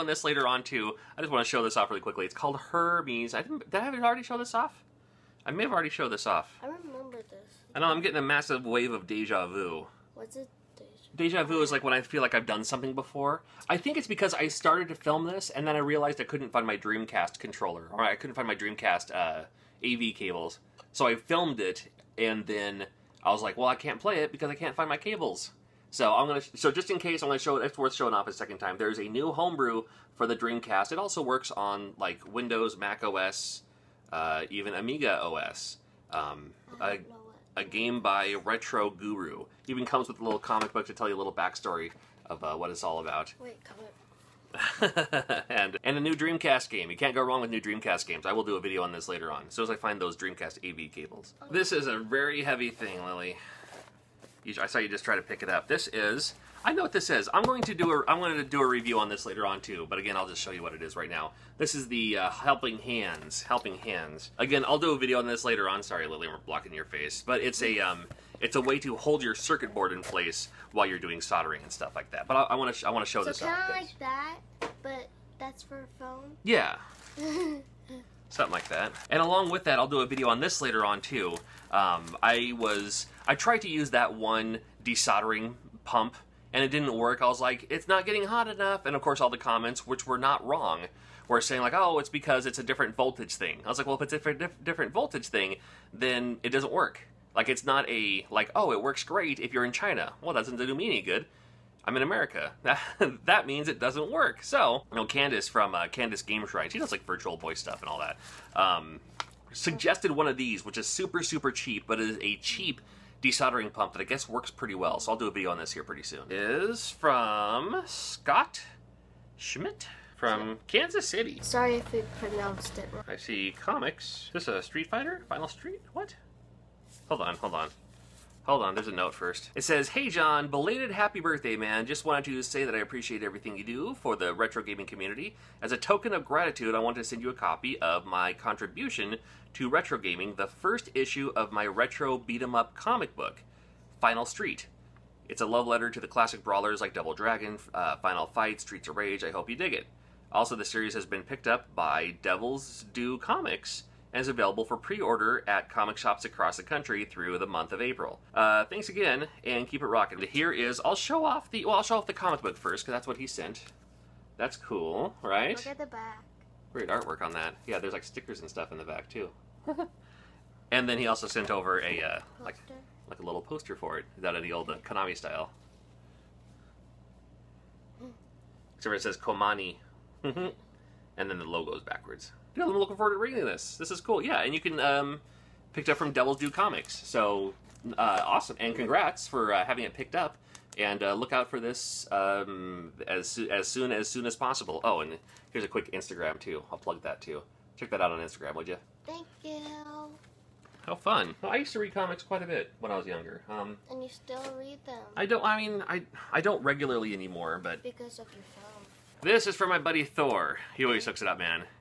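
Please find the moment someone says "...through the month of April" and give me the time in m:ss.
2:37.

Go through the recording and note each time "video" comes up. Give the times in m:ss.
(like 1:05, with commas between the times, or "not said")
0:48, 1:04, 1:20, 1:55.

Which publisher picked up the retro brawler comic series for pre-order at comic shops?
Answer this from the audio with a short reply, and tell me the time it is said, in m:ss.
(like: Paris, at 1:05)
Devil's Due Comics, at 2:32.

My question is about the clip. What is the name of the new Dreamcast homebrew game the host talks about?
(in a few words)
Hermes.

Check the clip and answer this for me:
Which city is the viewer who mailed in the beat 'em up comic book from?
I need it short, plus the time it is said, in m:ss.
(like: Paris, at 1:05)
Kansas City, at 2:00.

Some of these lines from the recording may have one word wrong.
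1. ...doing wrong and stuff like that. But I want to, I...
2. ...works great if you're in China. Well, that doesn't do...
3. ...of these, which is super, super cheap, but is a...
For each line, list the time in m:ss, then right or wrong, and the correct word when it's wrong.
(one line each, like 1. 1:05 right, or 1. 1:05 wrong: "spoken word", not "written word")
1. 1:10 wrong: "soldering", not "wrong"
2. 1:38 right
3. 1:50 right.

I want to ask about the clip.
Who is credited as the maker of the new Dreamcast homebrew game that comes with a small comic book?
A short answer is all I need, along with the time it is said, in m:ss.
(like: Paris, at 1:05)
Retro Guru, at 0:38.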